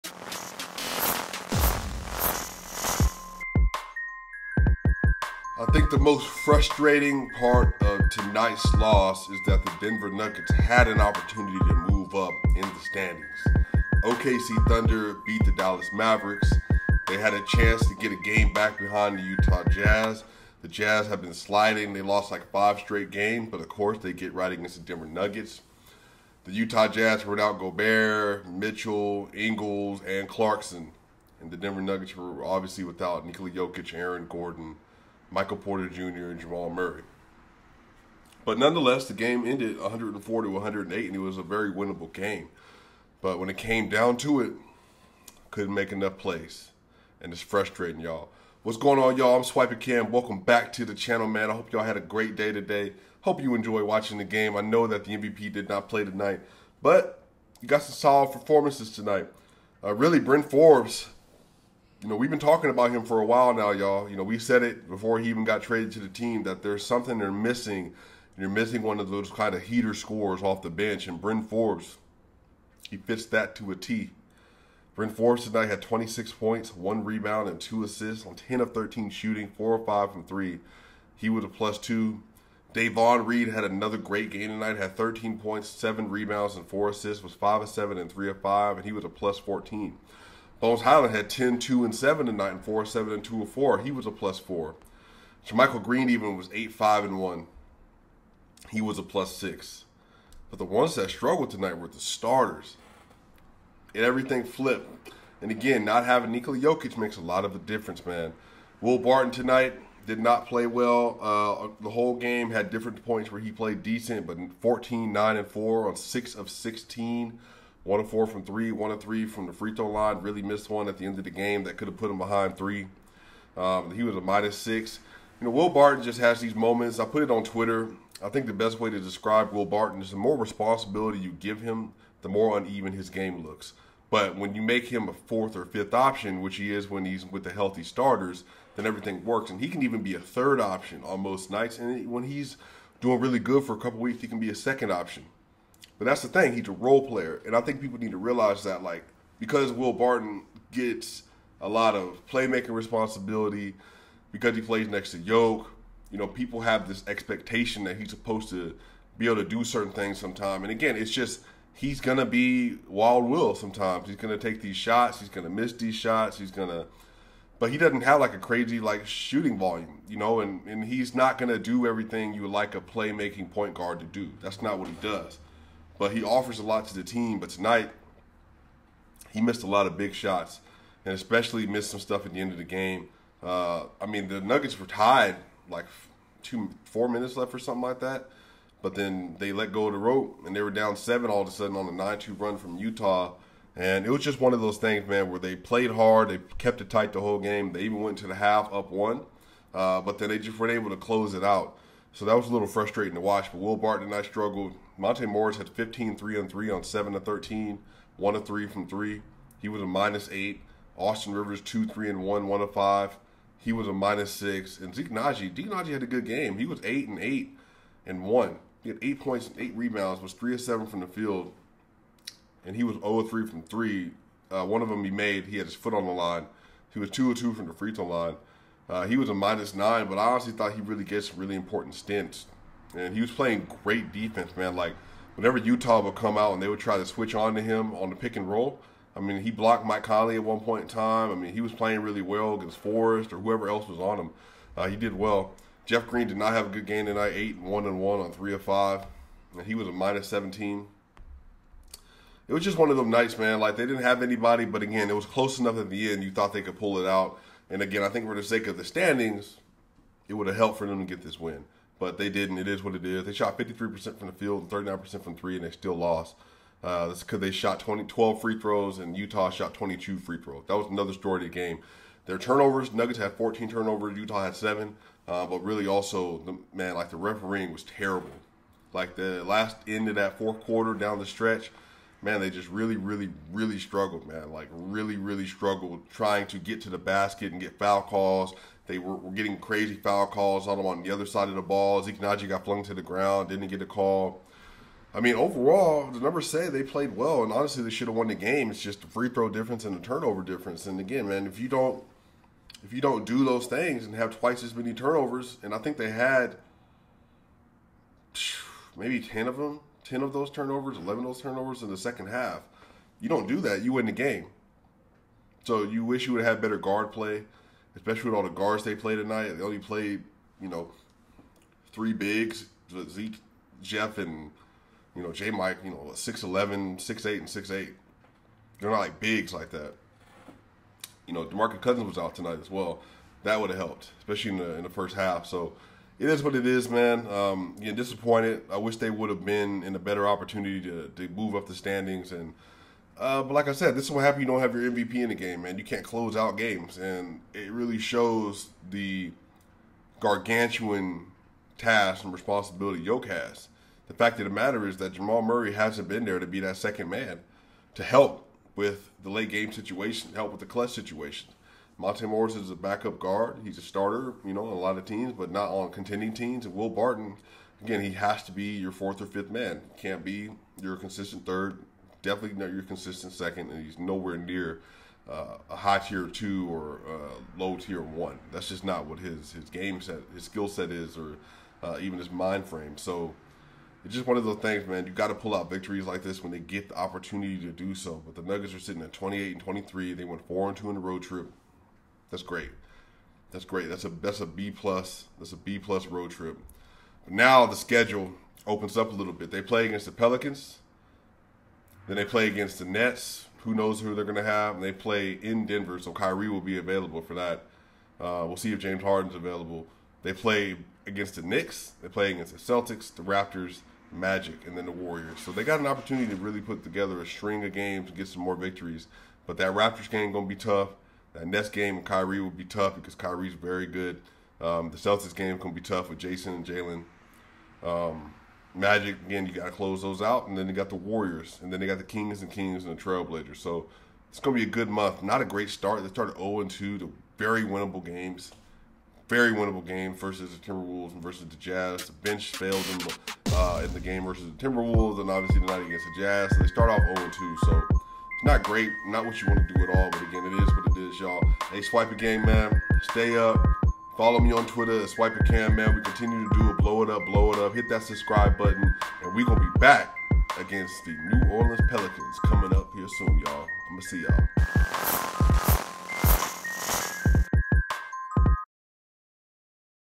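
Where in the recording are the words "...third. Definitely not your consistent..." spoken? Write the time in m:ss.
6:11.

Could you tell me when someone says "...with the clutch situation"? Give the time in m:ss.
6:00.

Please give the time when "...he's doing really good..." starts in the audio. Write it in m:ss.
2:22.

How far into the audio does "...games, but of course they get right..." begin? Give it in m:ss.
0:23.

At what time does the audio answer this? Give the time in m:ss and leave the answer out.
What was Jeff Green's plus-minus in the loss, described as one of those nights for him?
4:09.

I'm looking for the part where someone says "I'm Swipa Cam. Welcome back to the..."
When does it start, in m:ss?
0:49.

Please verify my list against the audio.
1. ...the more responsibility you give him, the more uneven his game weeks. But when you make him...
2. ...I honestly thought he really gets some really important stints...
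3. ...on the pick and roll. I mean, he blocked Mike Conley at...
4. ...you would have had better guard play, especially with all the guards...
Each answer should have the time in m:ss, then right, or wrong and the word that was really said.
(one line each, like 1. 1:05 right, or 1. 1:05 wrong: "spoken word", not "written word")
1. 2:10 wrong: "looks", not "weeks"
2. 3:50 right
3. 3:57 right
4. 5:16 right.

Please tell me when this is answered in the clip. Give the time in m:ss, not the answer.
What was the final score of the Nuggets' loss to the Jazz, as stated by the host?
0:39.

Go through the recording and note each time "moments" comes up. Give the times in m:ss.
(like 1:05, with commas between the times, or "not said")
2:06.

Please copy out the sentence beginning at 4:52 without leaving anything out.
Zeke got flung to the ground, didn't get a call.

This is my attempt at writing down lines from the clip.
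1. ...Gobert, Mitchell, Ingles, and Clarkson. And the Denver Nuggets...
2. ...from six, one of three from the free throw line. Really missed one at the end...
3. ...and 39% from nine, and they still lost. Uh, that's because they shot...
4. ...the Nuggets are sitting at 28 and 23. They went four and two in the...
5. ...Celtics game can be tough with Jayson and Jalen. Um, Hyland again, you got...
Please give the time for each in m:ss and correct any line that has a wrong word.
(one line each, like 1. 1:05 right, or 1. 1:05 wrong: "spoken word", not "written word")
1. 0:27 right
2. 1:58 wrong: "three", not "six"
3. 4:24 wrong: "three", not "nine"
4. 6:28 right
5. 7:04 wrong: "Magic", not "Hyland".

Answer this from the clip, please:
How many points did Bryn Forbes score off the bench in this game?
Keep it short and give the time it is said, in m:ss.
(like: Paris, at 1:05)
26, at 1:15.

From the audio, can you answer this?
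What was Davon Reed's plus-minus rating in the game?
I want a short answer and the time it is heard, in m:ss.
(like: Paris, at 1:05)
plus 14, at 1:29.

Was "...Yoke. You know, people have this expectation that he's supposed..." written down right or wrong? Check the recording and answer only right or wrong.
right.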